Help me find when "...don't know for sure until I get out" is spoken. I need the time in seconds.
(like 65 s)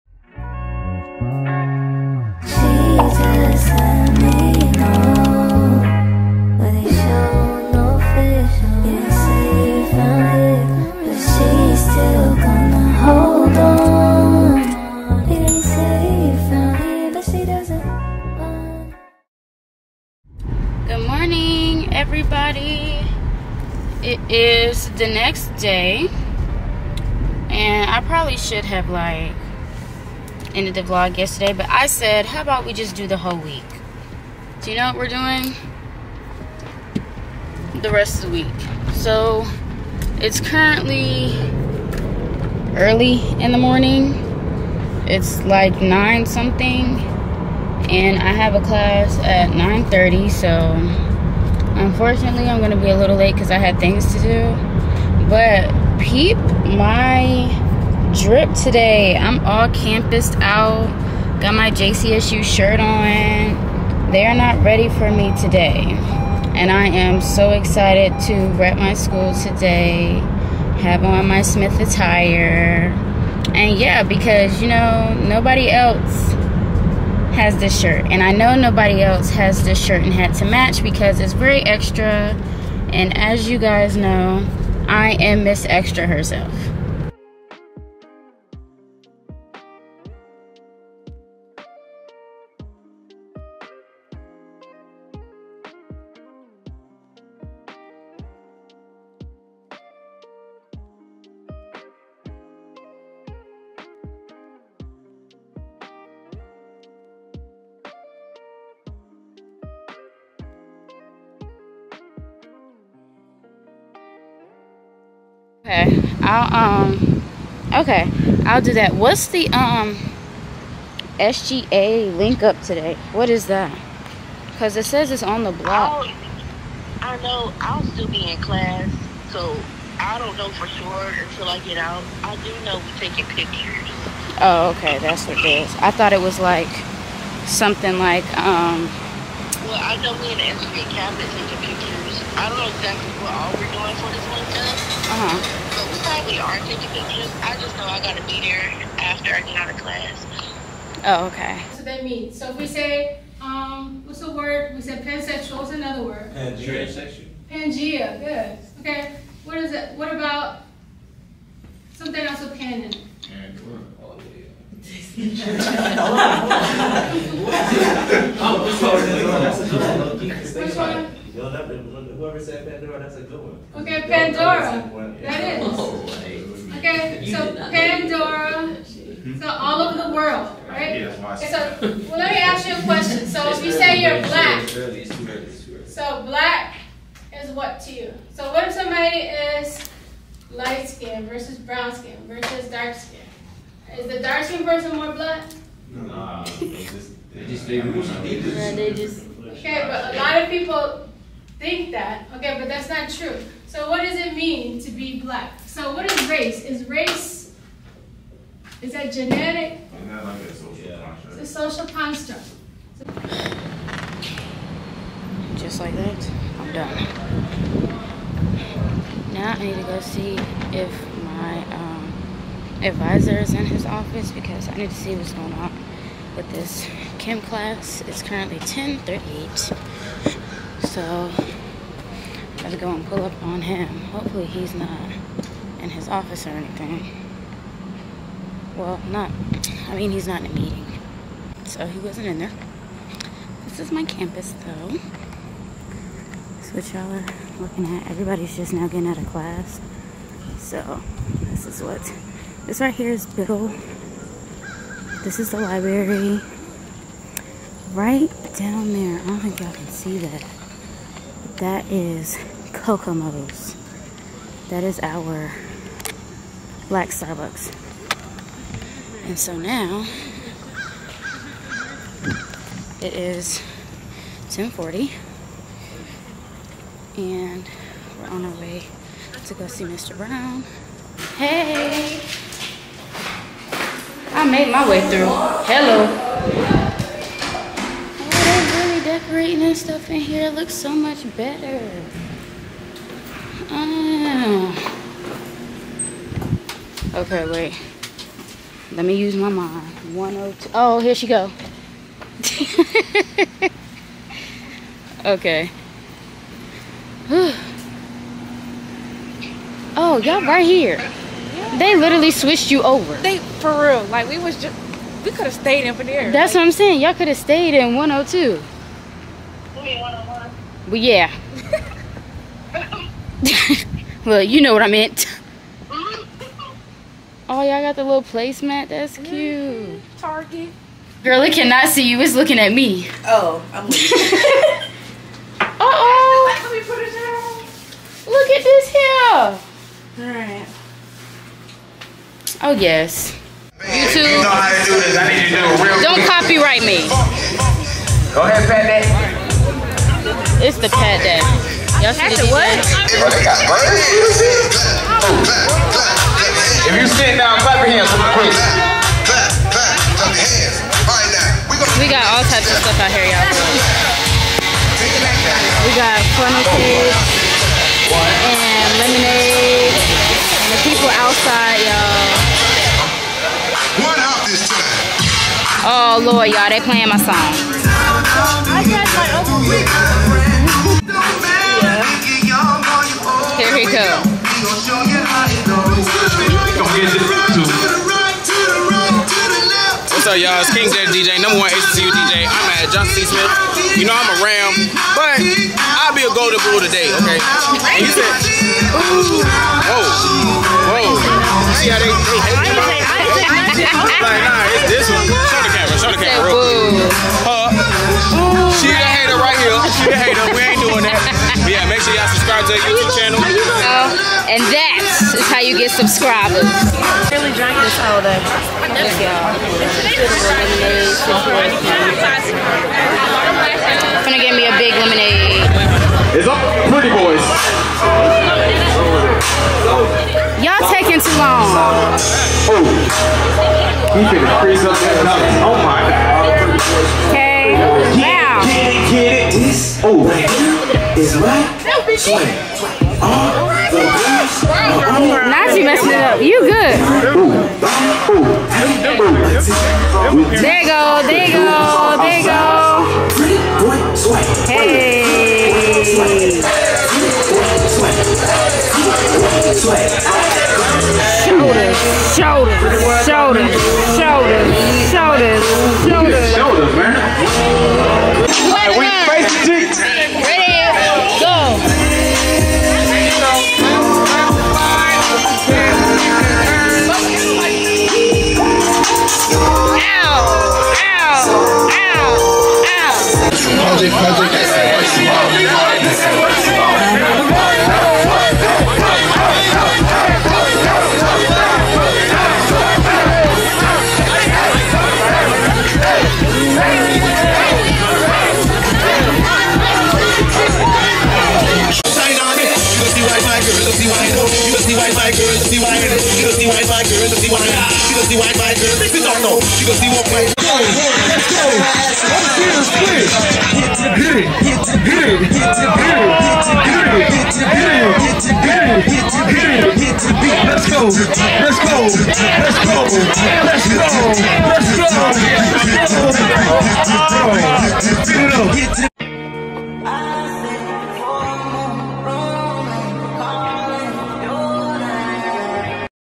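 130 s.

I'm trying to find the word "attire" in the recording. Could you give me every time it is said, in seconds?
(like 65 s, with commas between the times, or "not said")
71 s.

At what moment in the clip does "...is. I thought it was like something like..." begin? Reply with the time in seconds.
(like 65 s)
135 s.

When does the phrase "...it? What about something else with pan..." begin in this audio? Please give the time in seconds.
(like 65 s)
159 s.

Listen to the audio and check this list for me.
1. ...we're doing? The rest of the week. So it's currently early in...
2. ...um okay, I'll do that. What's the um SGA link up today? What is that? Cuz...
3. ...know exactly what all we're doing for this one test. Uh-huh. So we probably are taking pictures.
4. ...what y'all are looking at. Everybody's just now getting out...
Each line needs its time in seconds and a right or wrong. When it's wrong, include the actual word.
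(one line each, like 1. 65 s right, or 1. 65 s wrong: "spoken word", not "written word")
1. 34 s right
2. 116 s right
3. 142 s right
4. 246 s right.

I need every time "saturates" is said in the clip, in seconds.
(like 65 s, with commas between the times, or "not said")
not said.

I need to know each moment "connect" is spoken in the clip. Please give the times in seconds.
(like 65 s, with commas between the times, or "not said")
not said.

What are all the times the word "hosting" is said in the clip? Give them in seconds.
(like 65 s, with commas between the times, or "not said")
not said.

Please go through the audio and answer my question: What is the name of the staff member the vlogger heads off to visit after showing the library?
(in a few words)
Mr. Brown.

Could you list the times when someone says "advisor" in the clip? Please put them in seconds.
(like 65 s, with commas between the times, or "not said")
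222 s.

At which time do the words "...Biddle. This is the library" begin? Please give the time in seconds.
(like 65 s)
253 s.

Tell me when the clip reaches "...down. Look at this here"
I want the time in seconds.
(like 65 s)
337 s.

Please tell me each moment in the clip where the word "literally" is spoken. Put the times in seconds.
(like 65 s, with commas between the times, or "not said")
311 s.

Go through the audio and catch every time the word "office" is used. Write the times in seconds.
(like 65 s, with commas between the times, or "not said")
223 s, 236 s.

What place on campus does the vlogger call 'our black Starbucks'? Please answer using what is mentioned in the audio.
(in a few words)
Kokomo's.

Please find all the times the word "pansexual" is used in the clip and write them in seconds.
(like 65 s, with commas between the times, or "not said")
155 s.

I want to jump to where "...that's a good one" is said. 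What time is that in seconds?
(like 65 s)
172 s.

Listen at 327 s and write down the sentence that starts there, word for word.
Oh, y'all got the little placemat.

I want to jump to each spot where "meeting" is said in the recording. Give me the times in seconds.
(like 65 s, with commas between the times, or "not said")
240 s.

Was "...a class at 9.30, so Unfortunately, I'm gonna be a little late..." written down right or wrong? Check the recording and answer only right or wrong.
right.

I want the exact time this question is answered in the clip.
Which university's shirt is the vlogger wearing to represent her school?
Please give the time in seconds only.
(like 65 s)
61 s.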